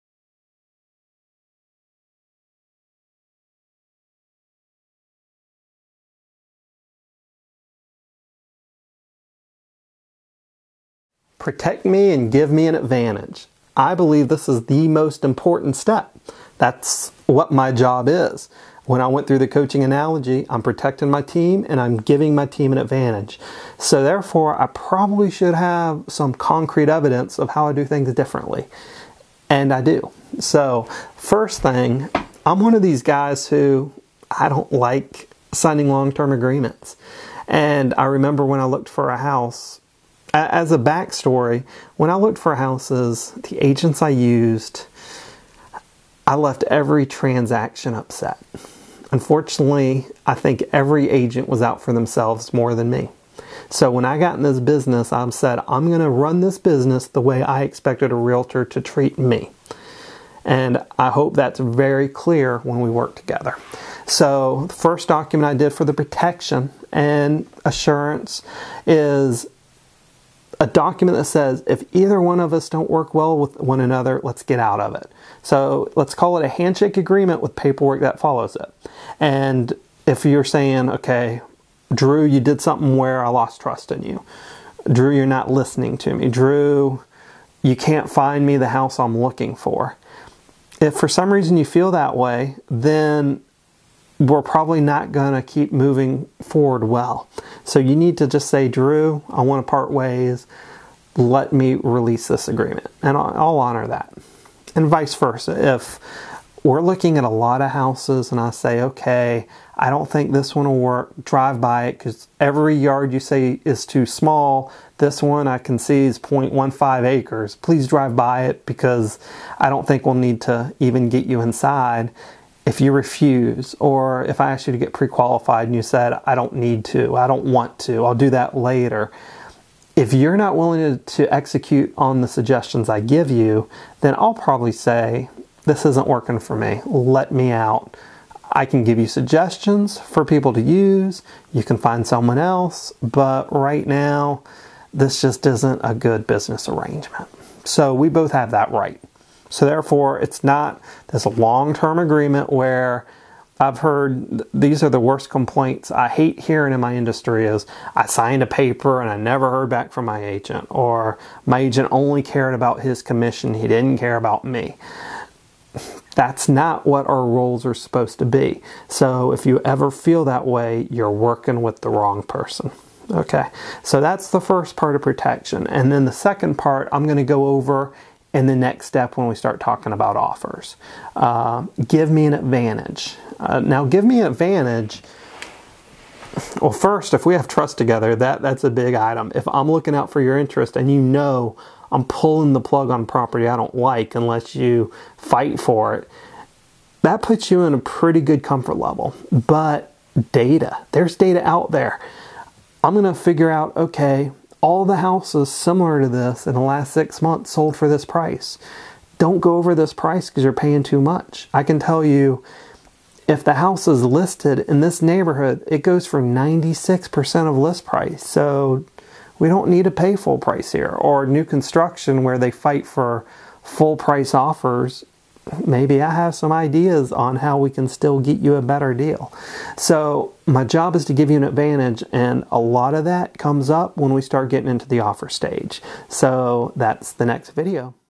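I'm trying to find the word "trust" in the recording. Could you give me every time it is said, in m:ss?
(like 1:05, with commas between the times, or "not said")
1:23, 3:07.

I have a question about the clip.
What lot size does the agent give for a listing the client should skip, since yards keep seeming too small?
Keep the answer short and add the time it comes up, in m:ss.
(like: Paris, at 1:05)
0.15 acres, at 1:56.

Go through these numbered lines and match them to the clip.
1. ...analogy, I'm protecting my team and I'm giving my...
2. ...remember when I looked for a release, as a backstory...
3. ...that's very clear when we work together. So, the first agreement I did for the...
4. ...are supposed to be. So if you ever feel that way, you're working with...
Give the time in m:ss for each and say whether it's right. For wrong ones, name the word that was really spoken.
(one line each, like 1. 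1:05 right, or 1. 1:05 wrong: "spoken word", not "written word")
1. 0:19 right
2. 0:38 wrong: "house", not "release"
3. 1:01 wrong: "document", not "agreement"
4. 2:47 right.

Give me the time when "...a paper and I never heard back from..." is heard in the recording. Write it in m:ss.
2:38.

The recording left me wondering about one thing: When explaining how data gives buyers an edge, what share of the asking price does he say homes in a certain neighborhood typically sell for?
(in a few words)
96%.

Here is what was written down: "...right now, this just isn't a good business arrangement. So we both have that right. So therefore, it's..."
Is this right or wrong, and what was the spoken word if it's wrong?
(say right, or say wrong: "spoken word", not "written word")
right.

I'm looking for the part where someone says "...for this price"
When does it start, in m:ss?
3:27.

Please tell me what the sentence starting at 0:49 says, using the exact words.
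Unfortunately, I think every agent was out for themselves more than me.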